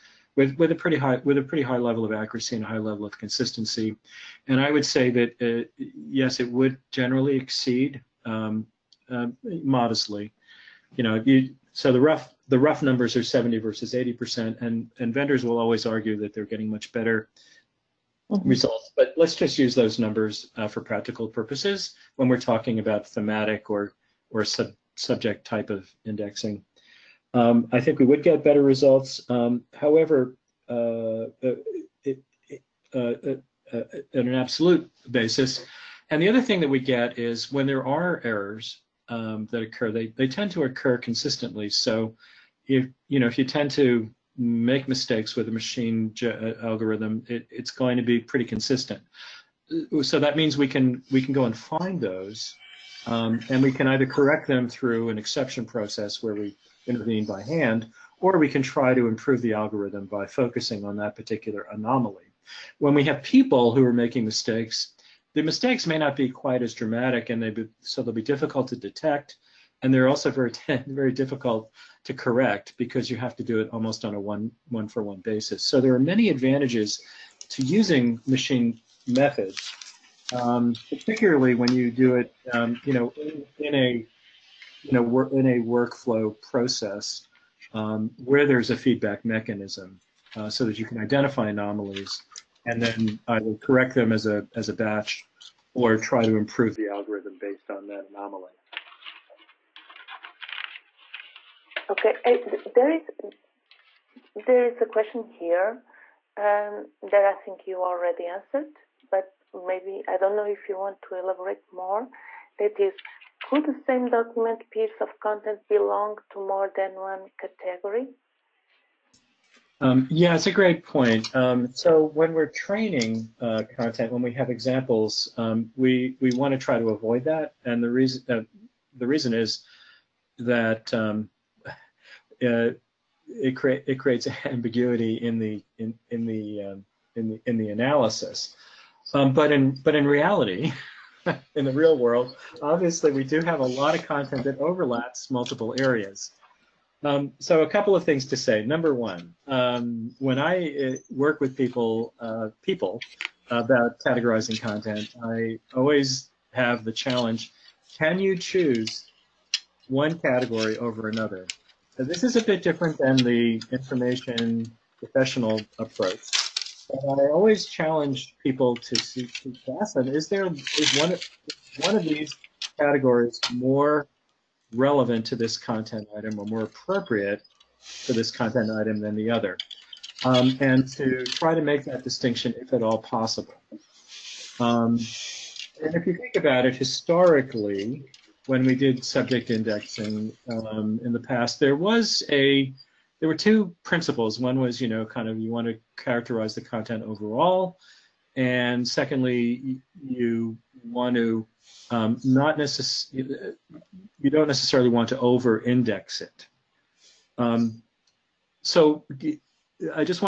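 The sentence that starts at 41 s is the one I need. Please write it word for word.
So if you know if you tend to make mistakes with a machine algorithm, it, it's going to be pretty consistent.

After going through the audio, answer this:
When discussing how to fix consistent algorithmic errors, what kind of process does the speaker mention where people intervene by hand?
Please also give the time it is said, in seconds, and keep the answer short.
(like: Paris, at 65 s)
exception process, at 55 s.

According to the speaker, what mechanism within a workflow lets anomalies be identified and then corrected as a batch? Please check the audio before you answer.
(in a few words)
feedback mechanism.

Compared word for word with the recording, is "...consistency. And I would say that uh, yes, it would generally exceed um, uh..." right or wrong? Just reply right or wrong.
right.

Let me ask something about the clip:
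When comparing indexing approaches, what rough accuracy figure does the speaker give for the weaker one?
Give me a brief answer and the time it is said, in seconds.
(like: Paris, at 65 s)
70, at 13 s.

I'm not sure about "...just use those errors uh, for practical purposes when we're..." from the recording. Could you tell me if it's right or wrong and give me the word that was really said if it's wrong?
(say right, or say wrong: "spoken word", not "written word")
wrong: "numbers", not "errors".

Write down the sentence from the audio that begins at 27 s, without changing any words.
Um, I think we would get better results.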